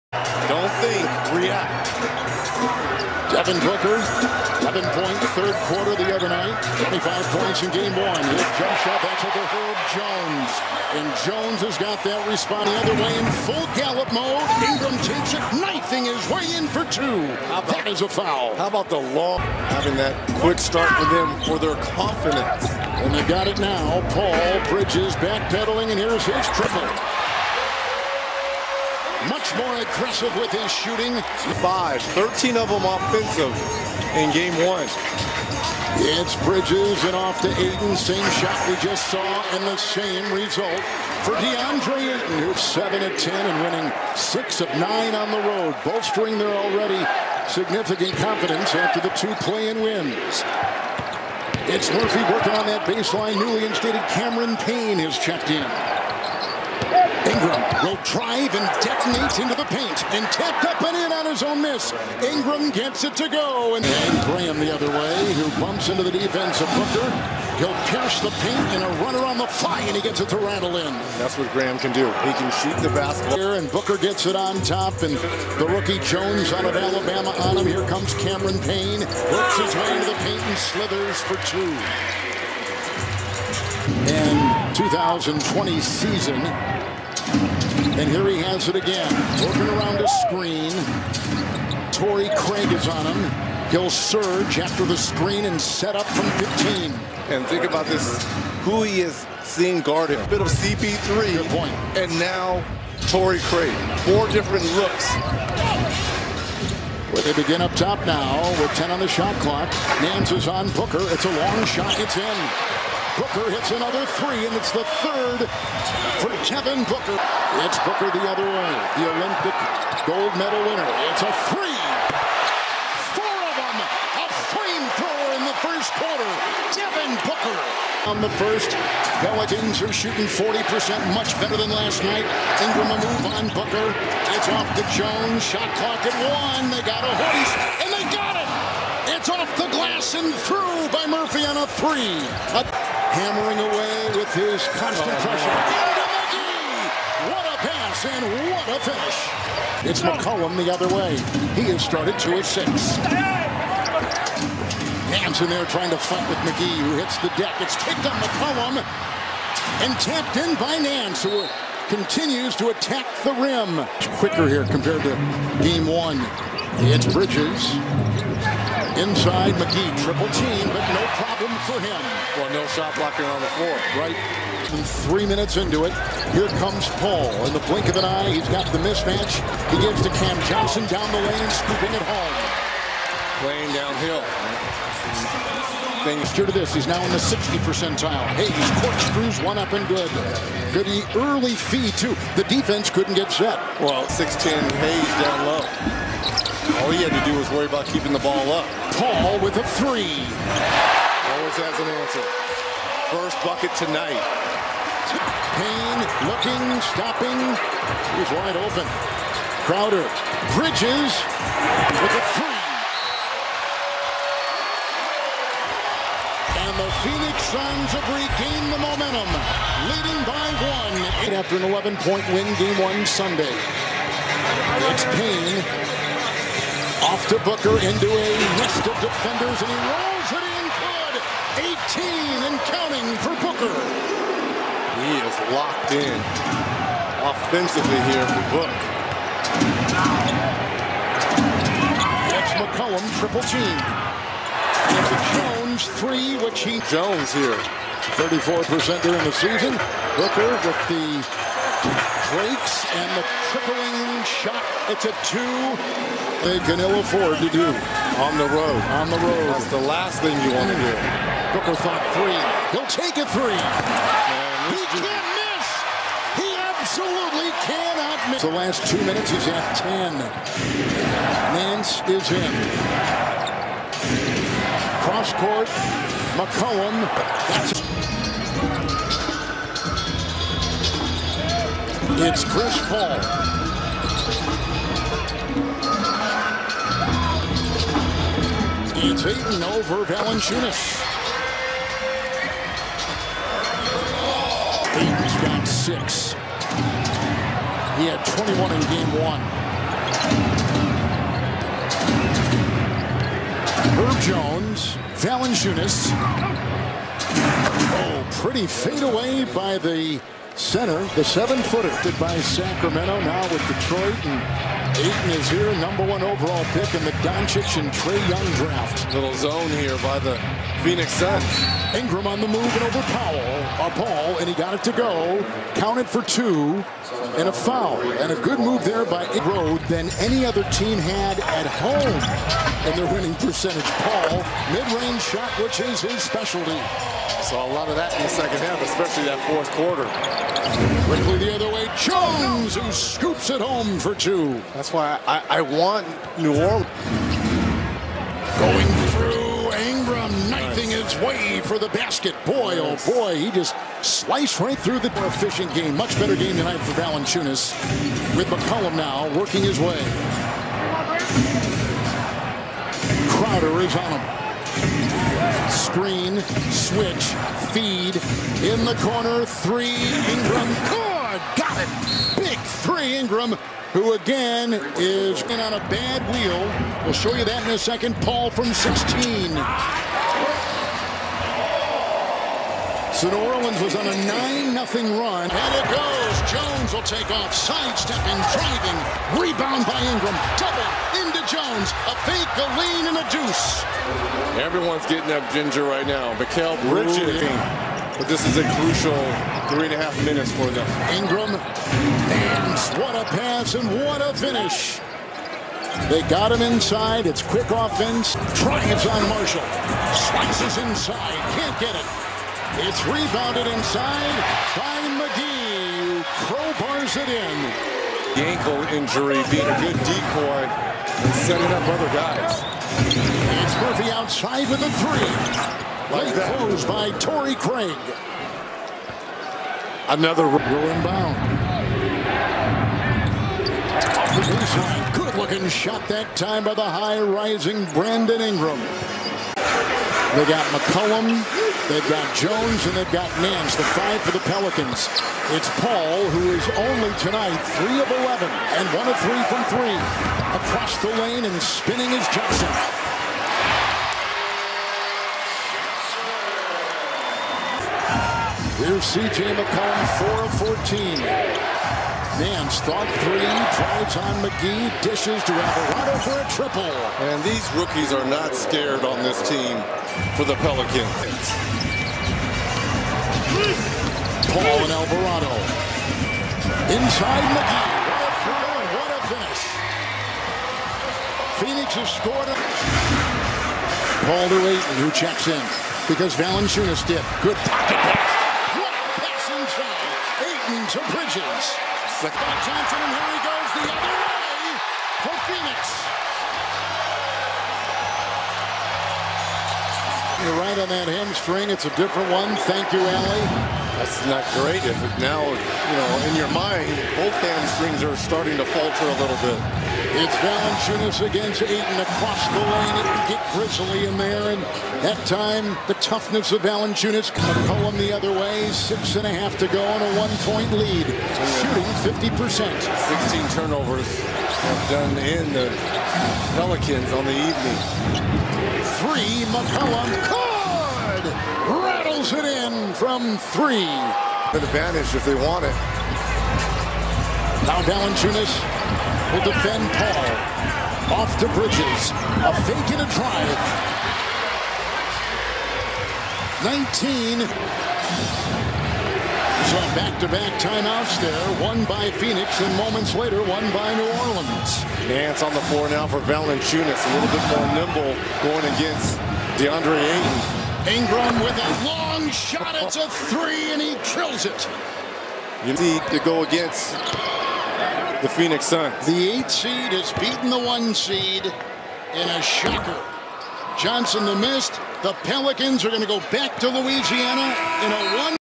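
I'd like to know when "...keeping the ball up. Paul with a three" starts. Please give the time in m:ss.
3:17.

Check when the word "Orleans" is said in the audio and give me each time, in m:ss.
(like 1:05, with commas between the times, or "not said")
5:46, 6:23, 9:14.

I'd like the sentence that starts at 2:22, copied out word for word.
A hammering away with his constant oh, pressure.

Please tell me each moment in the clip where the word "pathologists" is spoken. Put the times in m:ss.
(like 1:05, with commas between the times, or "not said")
not said.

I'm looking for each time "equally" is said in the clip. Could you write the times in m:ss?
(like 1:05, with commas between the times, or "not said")
not said.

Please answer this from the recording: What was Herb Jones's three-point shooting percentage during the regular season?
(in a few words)
34%.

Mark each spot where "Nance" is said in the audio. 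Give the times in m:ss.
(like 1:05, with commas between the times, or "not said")
1:50, 2:40, 4:31, 7:23, 7:42, 9:15.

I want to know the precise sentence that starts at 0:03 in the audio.
Devin Booker, 11 point third quarter the other night, 25 points in game one.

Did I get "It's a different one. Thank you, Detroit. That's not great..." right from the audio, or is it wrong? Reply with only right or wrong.
wrong.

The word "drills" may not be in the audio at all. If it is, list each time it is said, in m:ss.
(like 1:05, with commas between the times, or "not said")
9:24.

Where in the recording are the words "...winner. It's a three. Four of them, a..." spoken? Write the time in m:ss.
2:00.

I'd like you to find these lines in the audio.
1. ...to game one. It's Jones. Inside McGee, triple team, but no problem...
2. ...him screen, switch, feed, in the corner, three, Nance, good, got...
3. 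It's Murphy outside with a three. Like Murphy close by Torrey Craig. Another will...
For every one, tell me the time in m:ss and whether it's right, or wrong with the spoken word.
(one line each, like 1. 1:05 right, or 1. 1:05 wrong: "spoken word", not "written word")
1. 2:45 wrong: "Bridges", not "Jones"
2. 6:04 wrong: "Ingram", not "Nance"
3. 7:03 wrong: "Late", not "Murphy".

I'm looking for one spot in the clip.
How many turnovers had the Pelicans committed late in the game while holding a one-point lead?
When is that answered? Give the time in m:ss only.
8:42.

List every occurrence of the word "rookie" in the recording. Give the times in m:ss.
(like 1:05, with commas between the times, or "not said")
1:15, 7:47.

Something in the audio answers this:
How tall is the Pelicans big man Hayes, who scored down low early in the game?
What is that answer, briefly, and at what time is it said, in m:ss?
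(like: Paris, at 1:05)
6'10, at 3:14.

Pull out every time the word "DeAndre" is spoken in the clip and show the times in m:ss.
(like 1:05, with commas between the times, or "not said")
0:41, 9:19.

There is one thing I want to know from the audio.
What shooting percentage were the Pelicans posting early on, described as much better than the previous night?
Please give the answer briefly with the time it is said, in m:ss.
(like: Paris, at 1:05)
40%, at 2:10.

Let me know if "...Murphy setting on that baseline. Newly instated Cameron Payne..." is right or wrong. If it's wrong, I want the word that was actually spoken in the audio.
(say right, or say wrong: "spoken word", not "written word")
wrong: "working", not "setting".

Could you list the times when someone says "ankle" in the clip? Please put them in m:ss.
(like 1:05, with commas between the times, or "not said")
6:58.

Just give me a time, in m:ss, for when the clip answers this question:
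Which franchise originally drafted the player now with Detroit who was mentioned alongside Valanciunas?
5:12.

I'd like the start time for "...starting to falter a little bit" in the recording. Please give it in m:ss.
8:28.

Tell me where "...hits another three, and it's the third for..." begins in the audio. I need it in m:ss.
1:53.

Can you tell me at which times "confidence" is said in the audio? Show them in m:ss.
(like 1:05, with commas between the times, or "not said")
0:21, 0:48.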